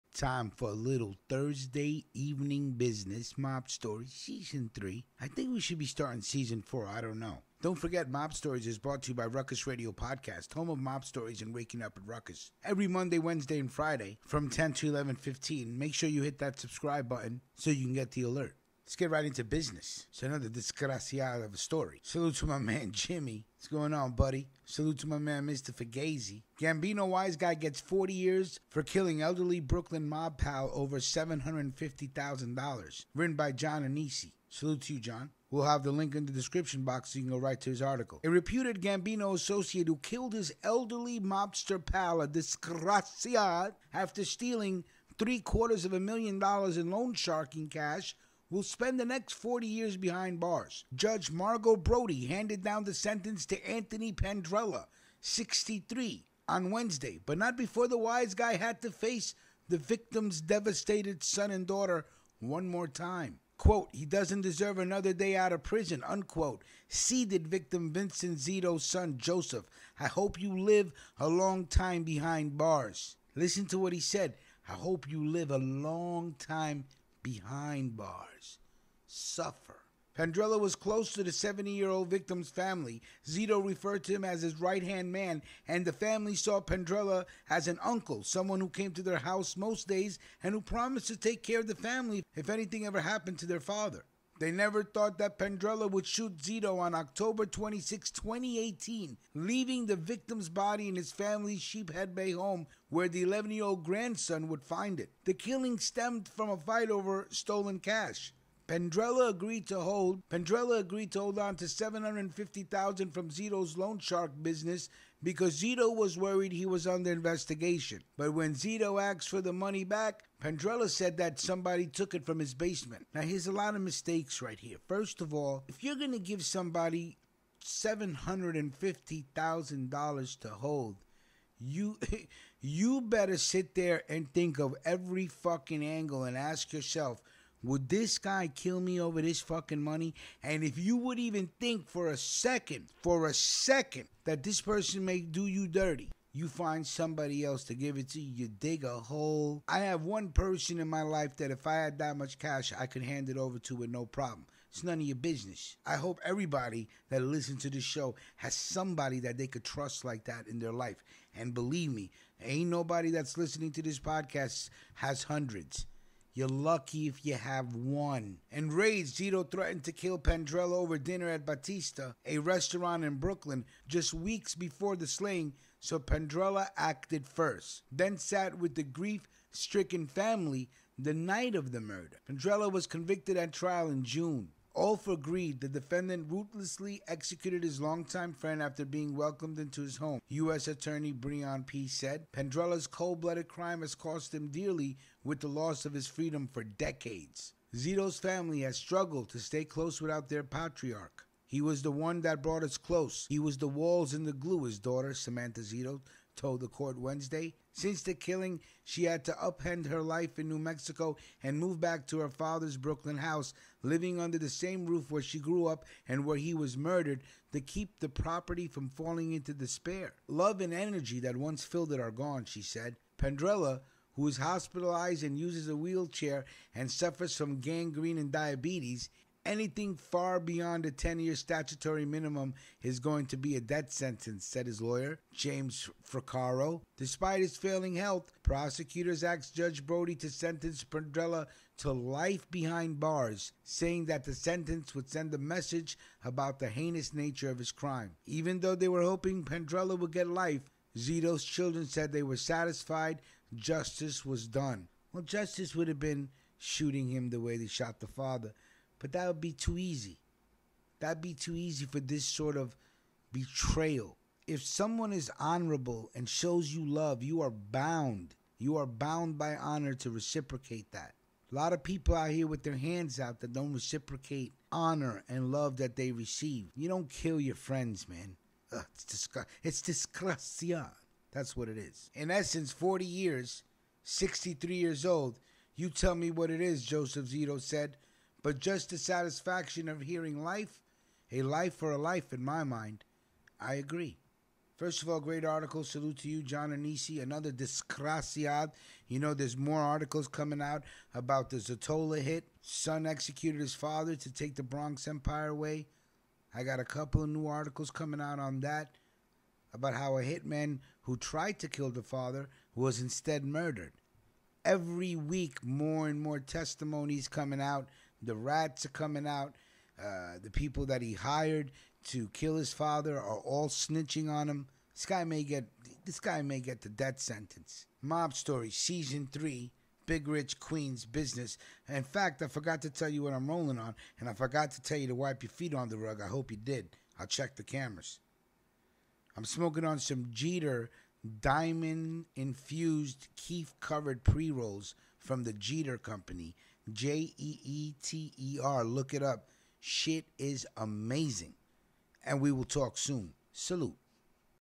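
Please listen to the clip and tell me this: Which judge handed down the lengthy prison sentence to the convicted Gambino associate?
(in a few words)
Margo Brodie.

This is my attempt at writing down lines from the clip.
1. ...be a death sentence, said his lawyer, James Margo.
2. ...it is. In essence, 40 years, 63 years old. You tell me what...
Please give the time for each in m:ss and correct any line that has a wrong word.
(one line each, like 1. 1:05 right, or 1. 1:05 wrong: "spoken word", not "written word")
1. 3:53 wrong: "Fricaro", not "Margo"
2. 4:41 right.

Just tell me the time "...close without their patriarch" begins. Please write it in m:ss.
3:19.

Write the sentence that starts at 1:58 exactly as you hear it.
But when Zito asked for the money back, Pandrella said that somebody took it from his basement.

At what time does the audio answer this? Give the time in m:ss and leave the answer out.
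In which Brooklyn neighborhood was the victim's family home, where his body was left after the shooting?
1:41.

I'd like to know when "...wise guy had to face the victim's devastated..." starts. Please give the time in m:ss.
0:57.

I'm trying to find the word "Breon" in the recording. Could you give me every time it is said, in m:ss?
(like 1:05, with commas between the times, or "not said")
3:11.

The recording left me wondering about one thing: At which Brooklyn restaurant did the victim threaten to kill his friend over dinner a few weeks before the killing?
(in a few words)
Batista.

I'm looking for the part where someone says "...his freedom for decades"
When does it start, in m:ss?
3:15.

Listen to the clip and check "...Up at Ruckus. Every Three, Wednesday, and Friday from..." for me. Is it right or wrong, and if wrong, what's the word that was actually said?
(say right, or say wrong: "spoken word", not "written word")
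wrong: "Monday", not "Three".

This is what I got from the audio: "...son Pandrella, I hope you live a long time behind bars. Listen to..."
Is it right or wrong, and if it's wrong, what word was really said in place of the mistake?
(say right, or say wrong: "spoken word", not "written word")
wrong: "Joseph", not "Pandrella".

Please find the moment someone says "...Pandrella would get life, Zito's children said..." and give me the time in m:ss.
4:09.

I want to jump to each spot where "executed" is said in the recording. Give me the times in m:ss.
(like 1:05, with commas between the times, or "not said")
3:07, 5:03.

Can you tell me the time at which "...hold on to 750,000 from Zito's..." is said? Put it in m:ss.
1:51.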